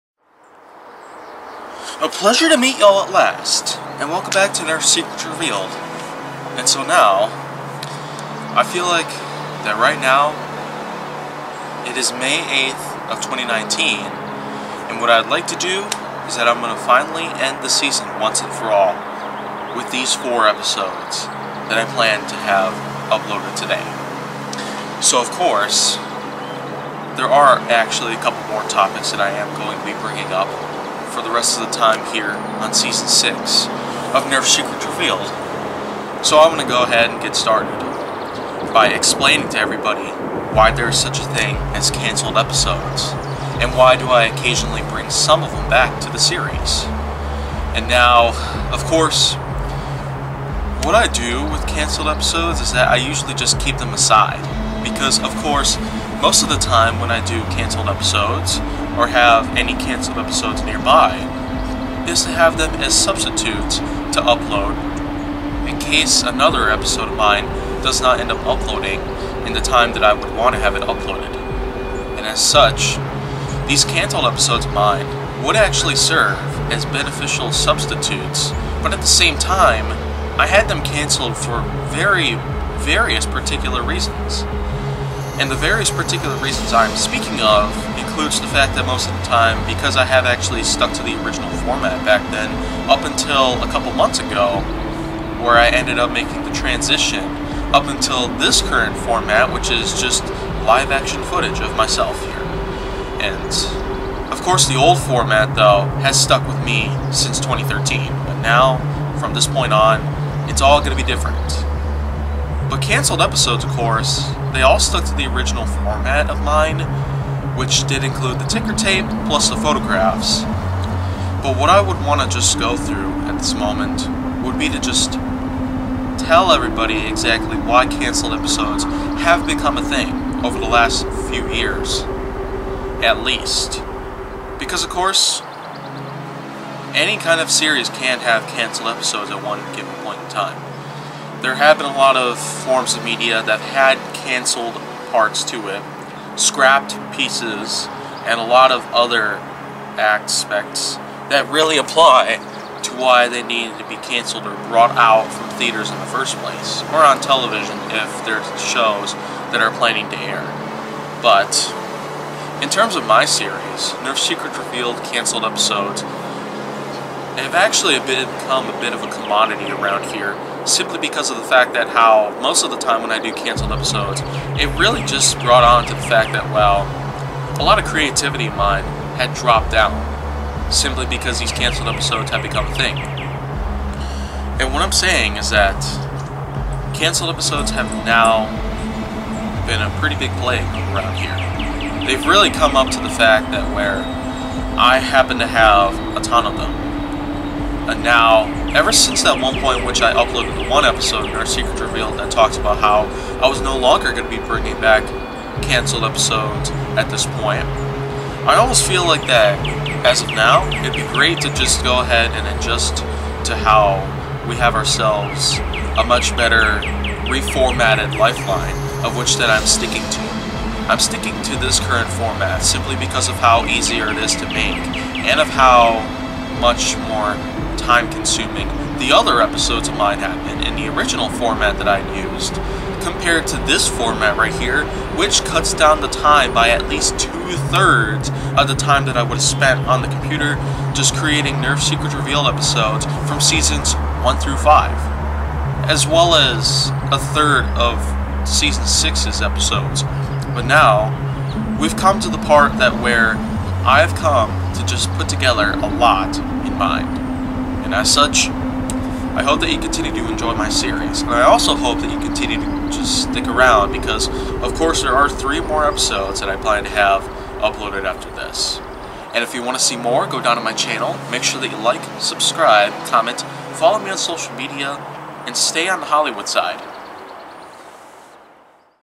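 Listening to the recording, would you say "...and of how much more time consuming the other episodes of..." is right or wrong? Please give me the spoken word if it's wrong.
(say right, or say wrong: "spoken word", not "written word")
right.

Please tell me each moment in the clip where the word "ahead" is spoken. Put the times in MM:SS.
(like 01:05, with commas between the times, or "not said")
00:36, 03:31.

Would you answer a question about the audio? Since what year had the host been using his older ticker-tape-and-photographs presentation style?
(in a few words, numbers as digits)
2013.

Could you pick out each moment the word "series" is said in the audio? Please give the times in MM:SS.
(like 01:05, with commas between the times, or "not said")
00:46, 02:17, 02:43, 04:20.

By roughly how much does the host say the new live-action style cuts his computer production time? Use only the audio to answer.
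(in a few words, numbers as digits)
two thirds.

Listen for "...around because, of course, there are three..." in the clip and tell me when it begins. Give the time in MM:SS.
04:23.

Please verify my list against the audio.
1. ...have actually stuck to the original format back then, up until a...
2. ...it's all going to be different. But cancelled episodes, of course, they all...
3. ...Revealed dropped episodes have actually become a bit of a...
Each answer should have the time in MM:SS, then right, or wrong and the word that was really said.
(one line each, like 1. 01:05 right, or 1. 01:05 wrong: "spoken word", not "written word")
1. 01:30 right
2. 01:50 right
3. 02:44 wrong: "canceled", not "dropped".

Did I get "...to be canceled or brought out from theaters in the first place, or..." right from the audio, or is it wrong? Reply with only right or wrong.
right.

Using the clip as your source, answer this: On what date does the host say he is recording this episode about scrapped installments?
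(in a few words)
May 8th, 2019.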